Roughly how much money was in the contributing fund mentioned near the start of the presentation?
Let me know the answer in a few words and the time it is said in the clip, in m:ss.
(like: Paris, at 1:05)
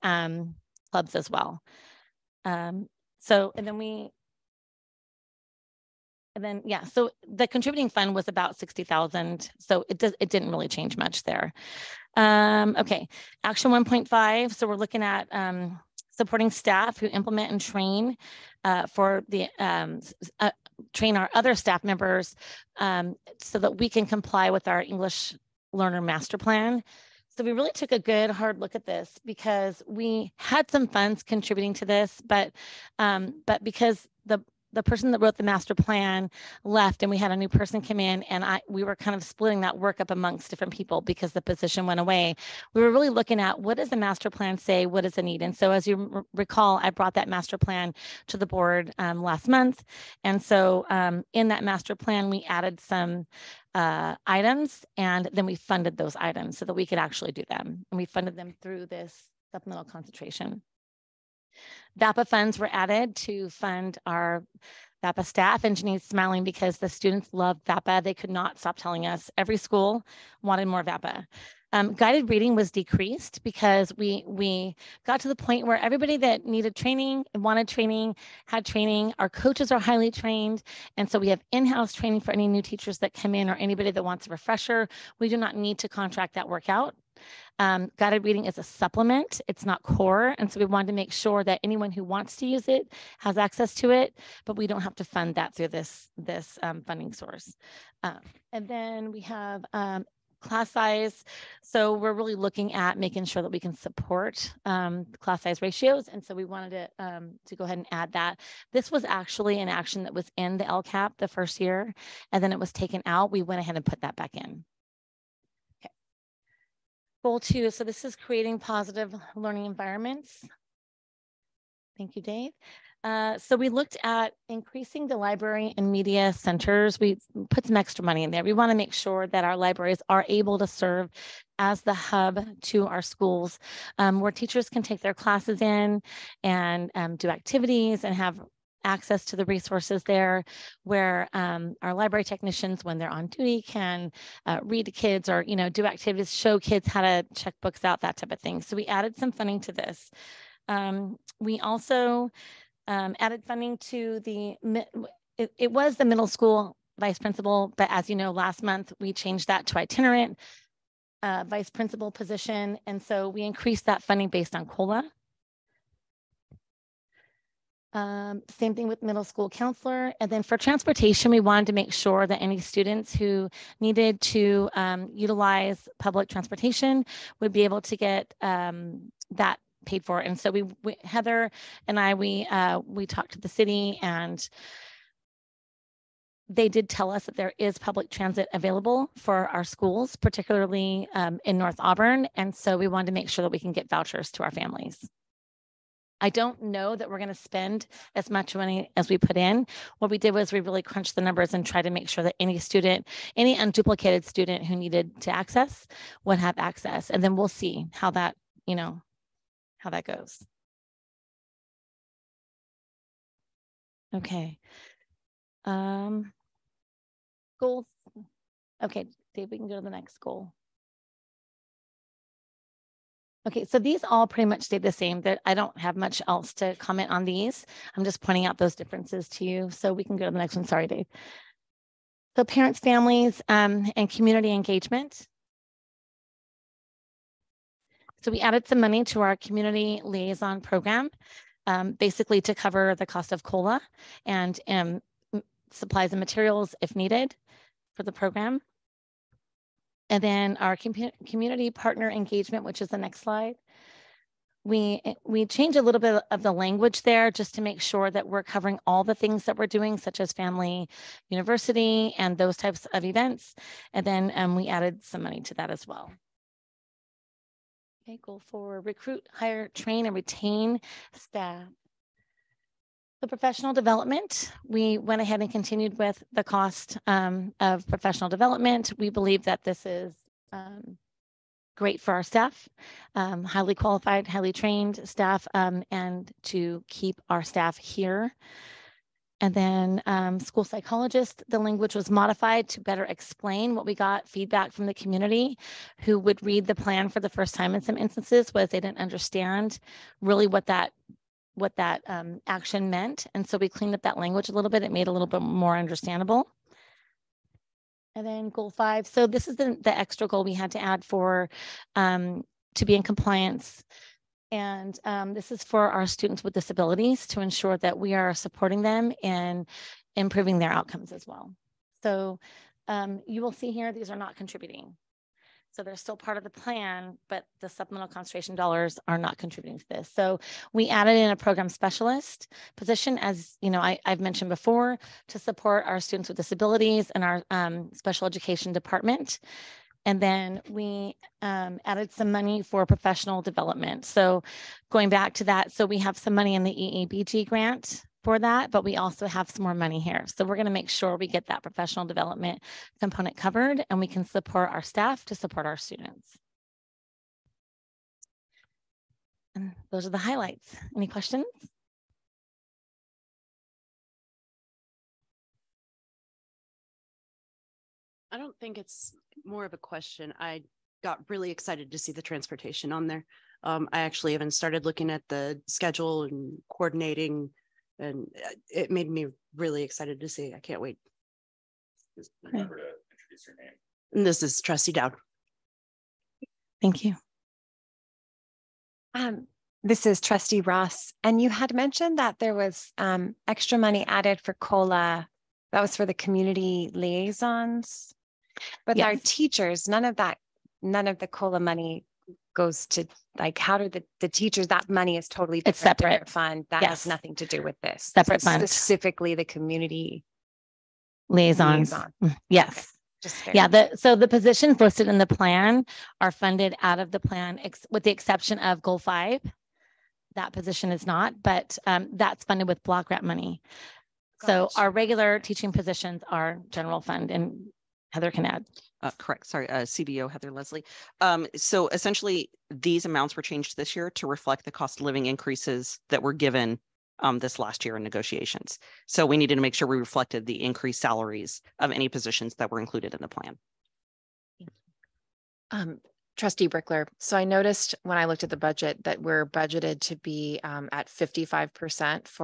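60,000, at 0:08.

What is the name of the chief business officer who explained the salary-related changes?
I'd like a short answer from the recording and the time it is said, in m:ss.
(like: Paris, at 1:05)
Heather Leslie, at 7:10.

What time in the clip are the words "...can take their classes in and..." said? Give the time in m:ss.
2:14.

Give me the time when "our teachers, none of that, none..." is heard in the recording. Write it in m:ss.
6:39.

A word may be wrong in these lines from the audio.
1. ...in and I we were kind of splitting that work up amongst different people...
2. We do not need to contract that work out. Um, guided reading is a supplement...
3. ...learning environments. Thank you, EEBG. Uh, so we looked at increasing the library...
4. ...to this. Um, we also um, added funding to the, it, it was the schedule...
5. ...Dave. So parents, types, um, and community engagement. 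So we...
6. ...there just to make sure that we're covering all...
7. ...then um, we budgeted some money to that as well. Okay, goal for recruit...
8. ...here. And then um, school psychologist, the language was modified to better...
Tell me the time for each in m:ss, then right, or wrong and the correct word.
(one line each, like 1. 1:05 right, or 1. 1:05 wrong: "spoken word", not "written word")
1. 0:37 right
2. 1:25 right
3. 1:59 wrong: "Dave", not "EEBG"
4. 2:29 wrong: "middle", not "schedule"
5. 3:50 wrong: "families", not "types"
6. 4:17 right
7. 4:24 wrong: "added", not "budgeted"
8. 4:47 right.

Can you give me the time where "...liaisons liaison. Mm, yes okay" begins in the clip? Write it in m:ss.
6:51.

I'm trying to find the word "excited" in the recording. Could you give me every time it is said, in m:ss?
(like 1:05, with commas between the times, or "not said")
6:11, 6:19.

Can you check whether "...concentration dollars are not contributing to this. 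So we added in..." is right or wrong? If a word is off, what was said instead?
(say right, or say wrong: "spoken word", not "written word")
right.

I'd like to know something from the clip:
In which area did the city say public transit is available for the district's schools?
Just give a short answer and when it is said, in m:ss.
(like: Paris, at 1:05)
North Auburn, at 3:11.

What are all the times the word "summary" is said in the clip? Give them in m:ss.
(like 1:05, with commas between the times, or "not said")
not said.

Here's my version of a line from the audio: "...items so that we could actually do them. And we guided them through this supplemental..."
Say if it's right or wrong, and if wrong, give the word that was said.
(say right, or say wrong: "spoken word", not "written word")
wrong: "funded", not "guided".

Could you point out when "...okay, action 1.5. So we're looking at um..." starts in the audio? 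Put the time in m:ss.
0:12.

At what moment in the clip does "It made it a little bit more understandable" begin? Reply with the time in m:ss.
5:04.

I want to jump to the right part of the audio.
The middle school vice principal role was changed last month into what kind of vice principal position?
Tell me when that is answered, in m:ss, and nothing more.
2:39.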